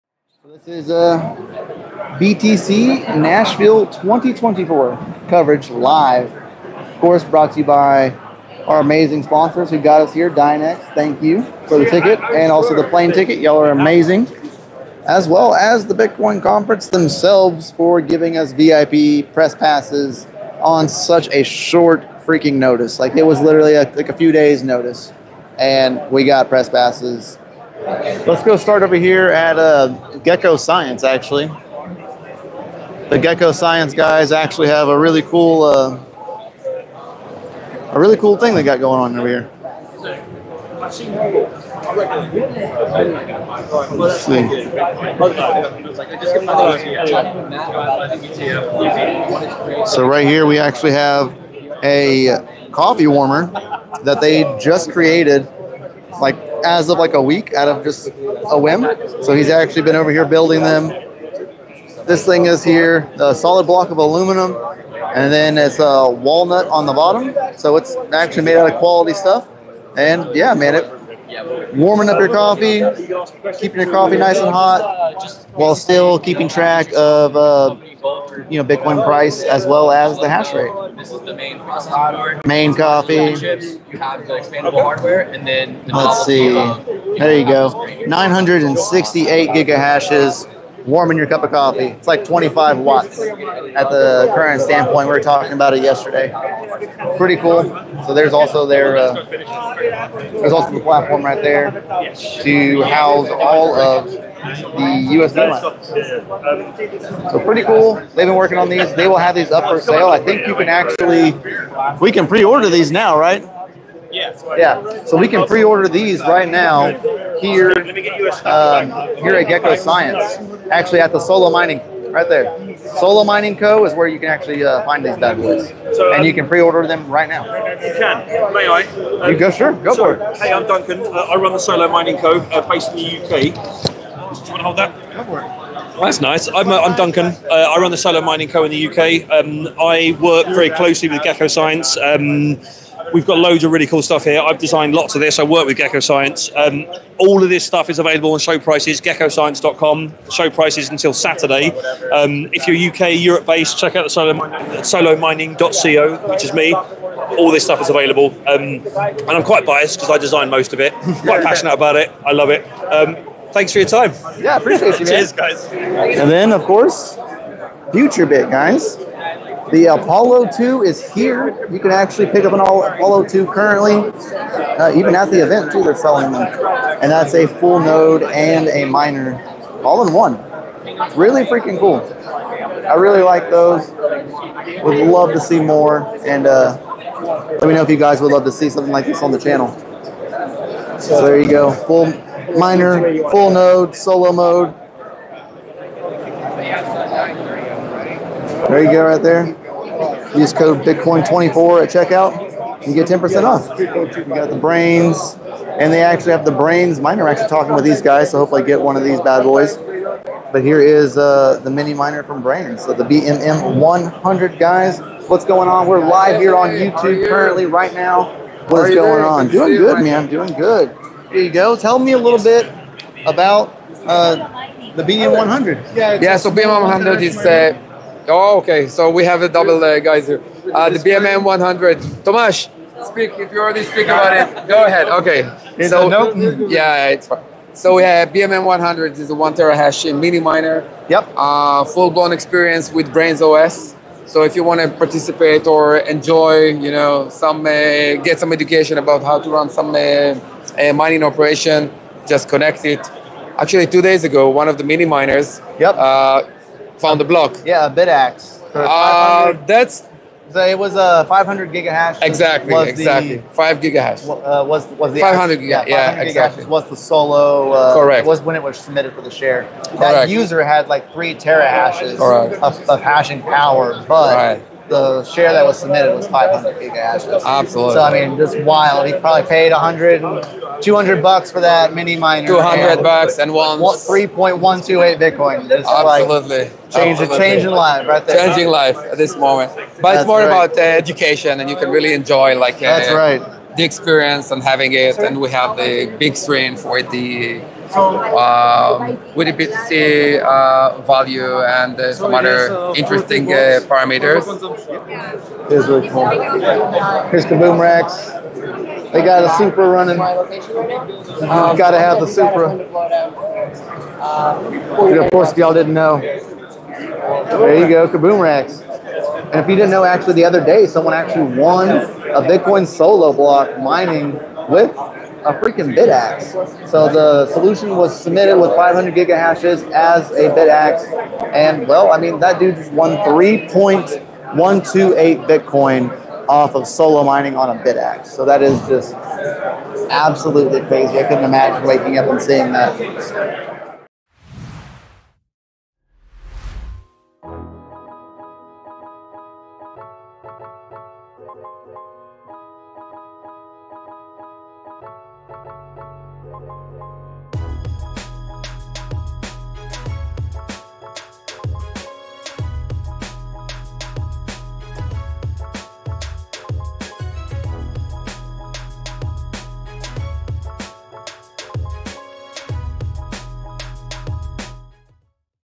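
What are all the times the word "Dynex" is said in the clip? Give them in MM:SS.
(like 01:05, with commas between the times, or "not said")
00:10.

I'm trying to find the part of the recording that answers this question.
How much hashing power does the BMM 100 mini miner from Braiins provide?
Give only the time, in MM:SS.
03:59.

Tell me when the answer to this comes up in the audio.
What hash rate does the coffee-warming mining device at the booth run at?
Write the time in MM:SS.
01:28.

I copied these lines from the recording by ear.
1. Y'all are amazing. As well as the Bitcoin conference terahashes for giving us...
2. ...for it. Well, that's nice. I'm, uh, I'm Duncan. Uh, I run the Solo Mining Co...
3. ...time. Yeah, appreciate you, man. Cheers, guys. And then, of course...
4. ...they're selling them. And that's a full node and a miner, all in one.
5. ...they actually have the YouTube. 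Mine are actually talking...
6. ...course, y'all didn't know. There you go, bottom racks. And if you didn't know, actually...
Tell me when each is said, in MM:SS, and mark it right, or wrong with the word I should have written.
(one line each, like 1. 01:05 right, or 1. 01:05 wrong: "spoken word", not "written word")
1. 00:13 wrong: "themselves", not "terahashes"
2. 02:15 right
3. 02:43 right
4. 02:55 right
5. 03:25 wrong: "Braiins", not "YouTube"
6. 05:15 wrong: "kaboom", not "bottom".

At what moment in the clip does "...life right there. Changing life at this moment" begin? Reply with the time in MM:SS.
04:47.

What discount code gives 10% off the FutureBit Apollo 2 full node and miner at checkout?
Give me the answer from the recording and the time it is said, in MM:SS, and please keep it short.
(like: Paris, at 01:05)
Bitcoin24, at 03:20.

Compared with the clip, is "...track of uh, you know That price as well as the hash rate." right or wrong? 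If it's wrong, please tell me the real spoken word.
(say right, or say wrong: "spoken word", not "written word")
wrong: "Bitcoin", not "That".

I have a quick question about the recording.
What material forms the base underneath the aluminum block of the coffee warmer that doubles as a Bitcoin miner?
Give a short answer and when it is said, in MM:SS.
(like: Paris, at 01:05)
Walnut, at 01:06.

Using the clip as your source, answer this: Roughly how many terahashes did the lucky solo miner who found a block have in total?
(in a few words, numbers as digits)
3 terahashes.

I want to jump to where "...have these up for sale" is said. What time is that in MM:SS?
01:49.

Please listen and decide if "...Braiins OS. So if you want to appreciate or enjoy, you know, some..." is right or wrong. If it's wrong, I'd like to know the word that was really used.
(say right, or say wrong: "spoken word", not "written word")
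wrong: "participate", not "appreciate".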